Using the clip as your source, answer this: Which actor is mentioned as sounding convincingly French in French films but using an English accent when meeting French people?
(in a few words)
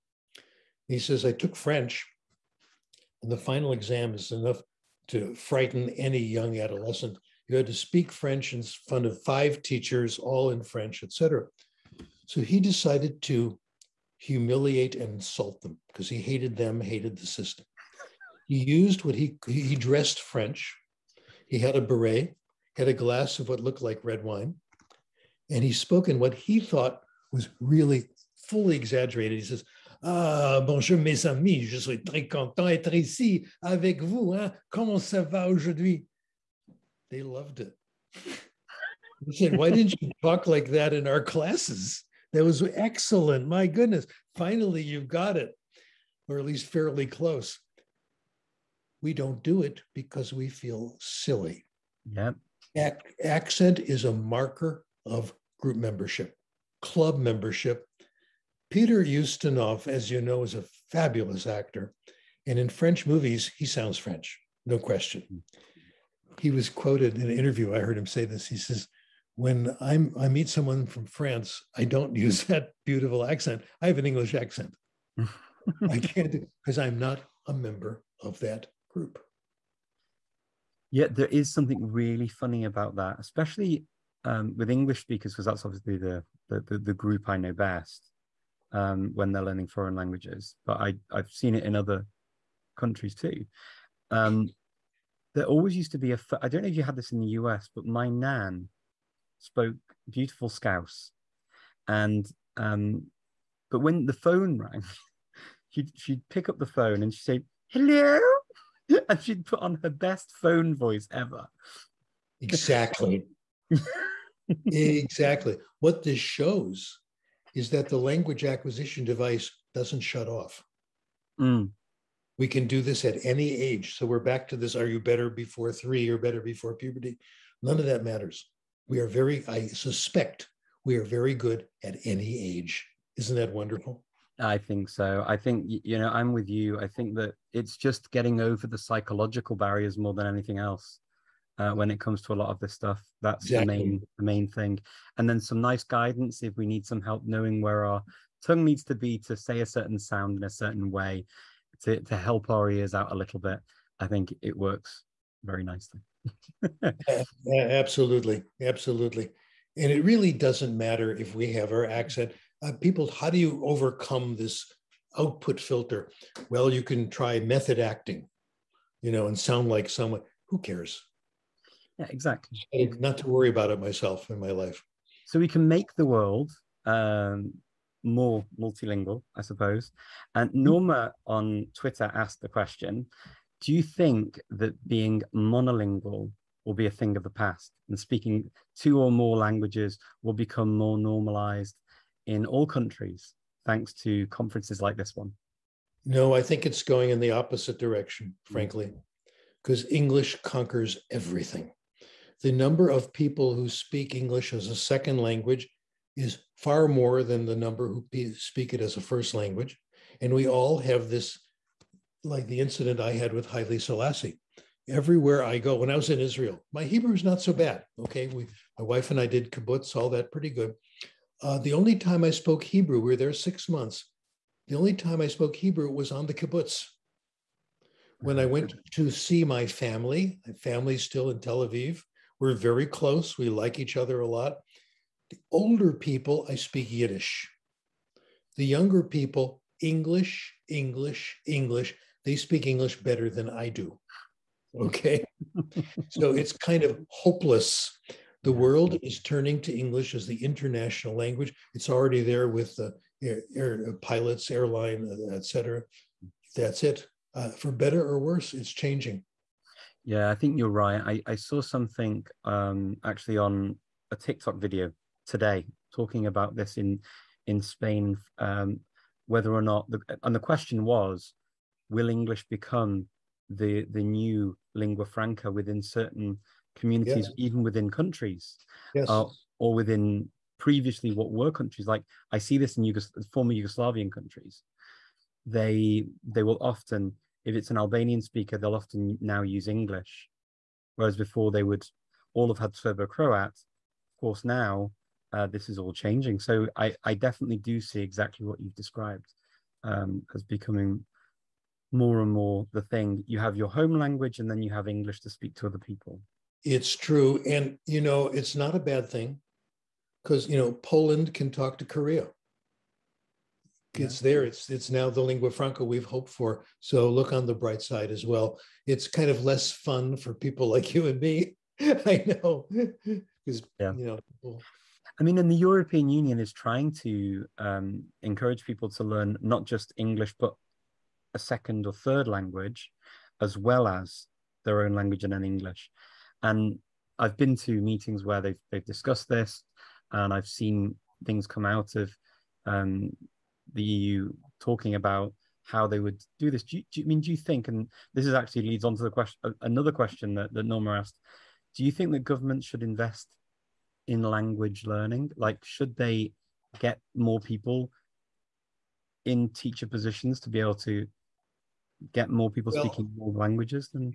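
Peter Ustinov.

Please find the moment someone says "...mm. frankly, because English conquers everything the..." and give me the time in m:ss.
3:18.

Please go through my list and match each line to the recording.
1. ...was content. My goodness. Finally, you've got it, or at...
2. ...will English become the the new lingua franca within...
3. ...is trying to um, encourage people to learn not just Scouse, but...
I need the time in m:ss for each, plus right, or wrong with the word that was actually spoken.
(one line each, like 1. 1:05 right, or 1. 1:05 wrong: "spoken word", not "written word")
1. 0:42 wrong: "excellent", not "content"
2. 4:31 right
3. 5:26 wrong: "English", not "Scouse".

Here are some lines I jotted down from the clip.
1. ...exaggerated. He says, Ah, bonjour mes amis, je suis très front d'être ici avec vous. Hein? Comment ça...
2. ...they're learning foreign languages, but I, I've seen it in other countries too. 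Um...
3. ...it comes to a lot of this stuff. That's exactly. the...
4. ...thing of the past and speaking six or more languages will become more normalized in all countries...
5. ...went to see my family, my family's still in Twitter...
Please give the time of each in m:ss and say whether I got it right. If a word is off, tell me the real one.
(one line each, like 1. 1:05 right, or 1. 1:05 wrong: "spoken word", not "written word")
1. 0:28 wrong: "content", not "front"
2. 1:29 right
3. 2:21 right
4. 3:06 wrong: "two", not "six"
5. 3:48 wrong: "Tel", not "Twitter".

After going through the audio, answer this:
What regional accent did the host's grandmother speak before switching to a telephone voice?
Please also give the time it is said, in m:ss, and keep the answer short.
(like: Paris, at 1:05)
Scouse, at 1:40.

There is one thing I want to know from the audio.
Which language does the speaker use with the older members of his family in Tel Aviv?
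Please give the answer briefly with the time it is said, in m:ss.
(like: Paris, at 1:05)
Yiddish, at 3:56.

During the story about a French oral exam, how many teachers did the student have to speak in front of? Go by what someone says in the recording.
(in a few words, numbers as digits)
5.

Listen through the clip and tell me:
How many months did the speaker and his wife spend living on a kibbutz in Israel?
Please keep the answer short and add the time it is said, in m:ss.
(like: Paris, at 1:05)
6, at 3:43.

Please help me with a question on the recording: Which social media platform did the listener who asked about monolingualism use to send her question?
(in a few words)
Twitter.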